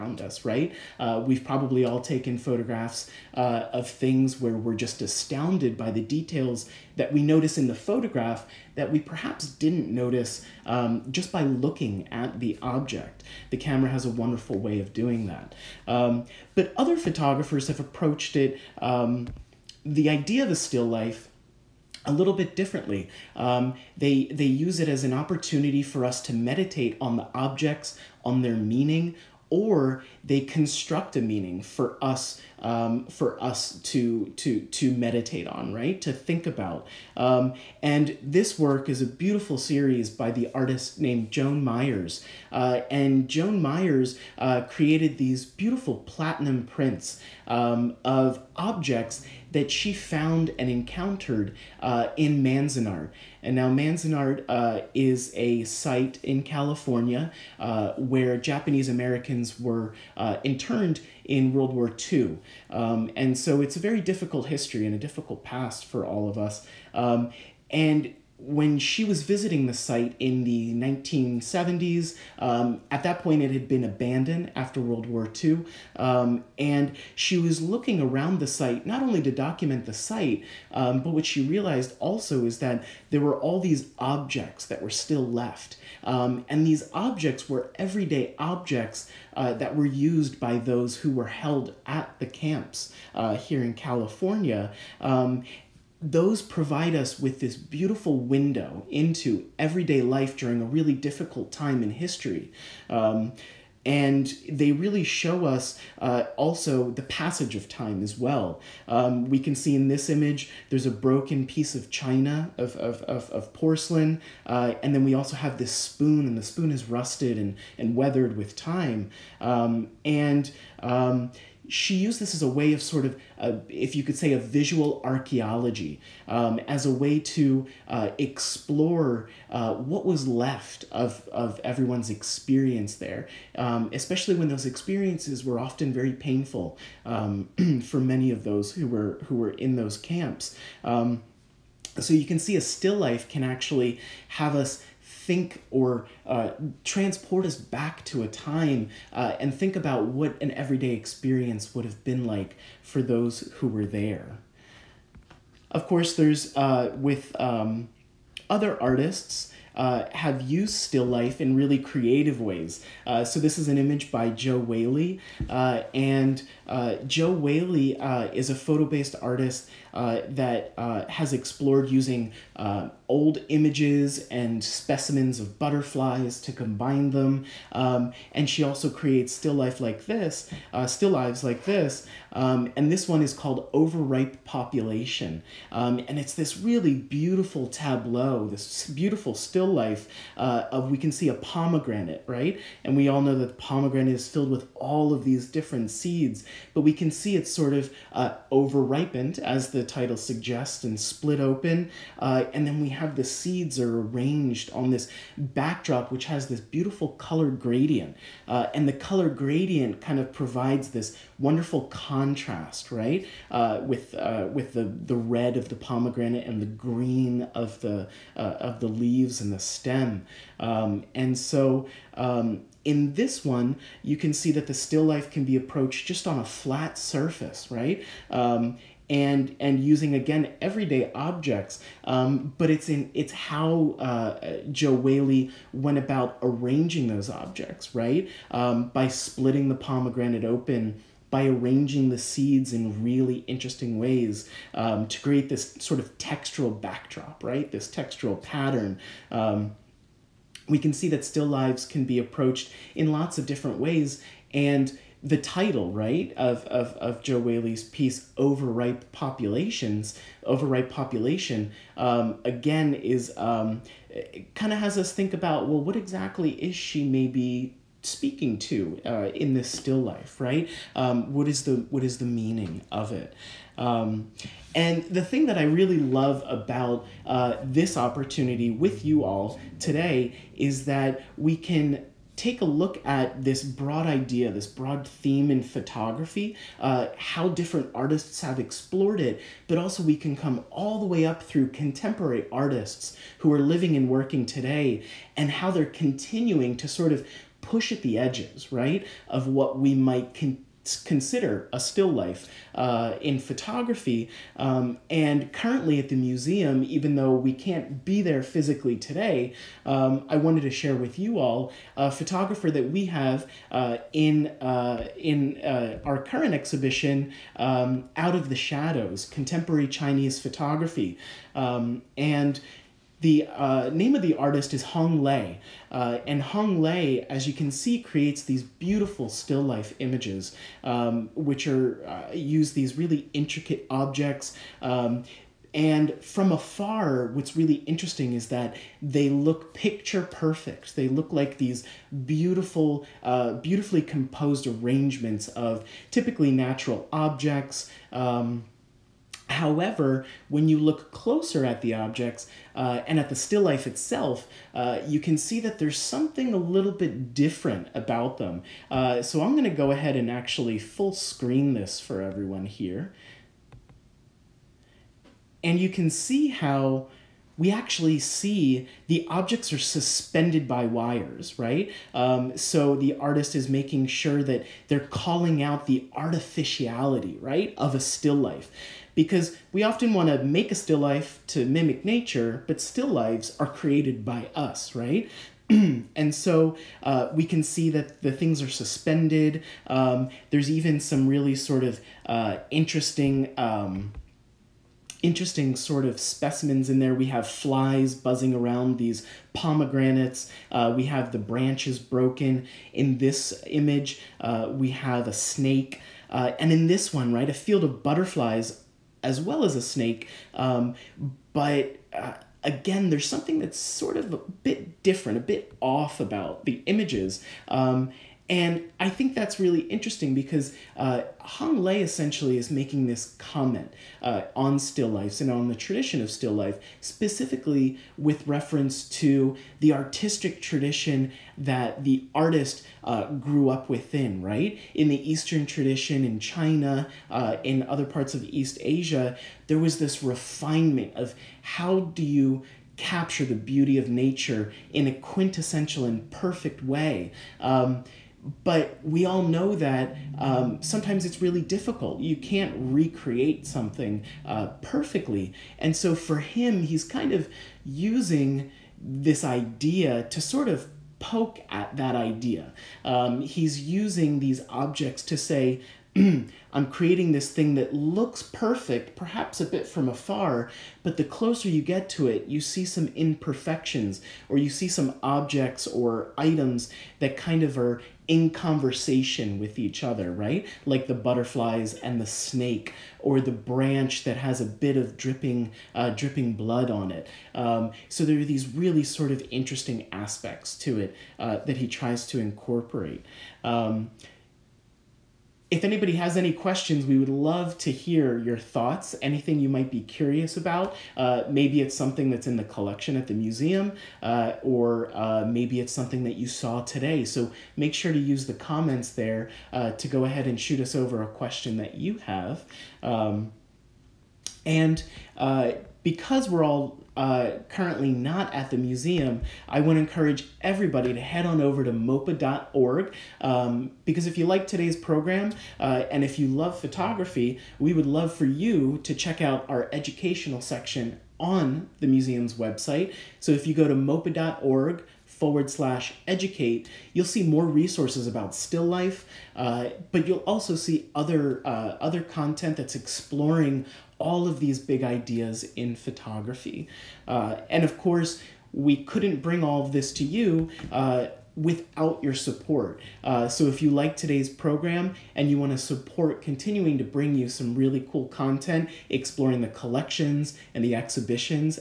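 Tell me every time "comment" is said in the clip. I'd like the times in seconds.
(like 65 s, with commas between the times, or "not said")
423 s, 508 s.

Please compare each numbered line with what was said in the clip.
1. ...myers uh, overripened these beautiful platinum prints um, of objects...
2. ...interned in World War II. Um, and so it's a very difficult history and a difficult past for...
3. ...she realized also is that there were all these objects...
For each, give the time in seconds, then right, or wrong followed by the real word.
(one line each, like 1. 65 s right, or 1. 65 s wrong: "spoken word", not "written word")
1. 43 s wrong: "created", not "overripened"
2. 60 s right
3. 81 s right.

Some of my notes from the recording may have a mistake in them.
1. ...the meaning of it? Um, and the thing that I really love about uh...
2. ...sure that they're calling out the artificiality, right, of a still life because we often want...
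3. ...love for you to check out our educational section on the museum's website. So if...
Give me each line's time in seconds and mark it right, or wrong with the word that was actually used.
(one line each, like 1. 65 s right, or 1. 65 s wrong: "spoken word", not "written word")
1. 272 s right
2. 374 s right
3. 528 s right.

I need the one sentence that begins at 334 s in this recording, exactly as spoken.
Um, and from afar, what's really interesting is that they look picture perfect.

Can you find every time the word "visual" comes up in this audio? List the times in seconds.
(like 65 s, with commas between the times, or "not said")
124 s.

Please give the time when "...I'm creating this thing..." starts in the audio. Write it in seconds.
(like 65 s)
466 s.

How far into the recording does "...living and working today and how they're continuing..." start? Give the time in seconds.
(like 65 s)
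293 s.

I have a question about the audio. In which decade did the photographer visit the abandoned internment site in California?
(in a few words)
1970s.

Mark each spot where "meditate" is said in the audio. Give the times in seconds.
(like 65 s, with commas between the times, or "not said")
26 s, 34 s.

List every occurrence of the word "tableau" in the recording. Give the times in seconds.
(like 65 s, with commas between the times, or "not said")
187 s.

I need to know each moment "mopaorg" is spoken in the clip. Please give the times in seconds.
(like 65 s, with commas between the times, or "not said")
521 s, 533 s.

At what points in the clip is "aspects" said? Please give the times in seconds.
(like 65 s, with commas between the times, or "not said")
490 s.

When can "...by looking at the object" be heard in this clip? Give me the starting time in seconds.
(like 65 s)
11 s.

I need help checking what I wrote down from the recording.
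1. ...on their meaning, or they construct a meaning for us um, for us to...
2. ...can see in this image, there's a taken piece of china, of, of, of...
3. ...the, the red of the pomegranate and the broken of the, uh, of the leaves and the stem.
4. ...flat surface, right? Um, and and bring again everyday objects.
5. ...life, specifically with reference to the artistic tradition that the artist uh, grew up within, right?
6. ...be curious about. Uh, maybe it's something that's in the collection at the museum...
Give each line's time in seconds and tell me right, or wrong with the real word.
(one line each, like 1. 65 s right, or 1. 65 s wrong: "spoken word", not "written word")
1. 28 s right
2. 109 s wrong: "broken", not "taken"
3. 214 s wrong: "green", not "broken"
4. 226 s wrong: "using", not "bring"
5. 426 s right
6. 499 s right.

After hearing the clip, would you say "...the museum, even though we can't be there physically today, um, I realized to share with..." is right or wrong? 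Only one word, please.
wrong.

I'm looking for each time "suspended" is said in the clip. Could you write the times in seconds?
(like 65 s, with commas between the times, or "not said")
369 s, 388 s.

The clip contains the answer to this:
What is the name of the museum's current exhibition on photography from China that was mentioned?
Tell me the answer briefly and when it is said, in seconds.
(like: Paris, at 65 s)
Out of the Shadows, at 318 s.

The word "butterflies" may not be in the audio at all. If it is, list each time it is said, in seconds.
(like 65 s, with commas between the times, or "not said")
175 s, 408 s, 481 s.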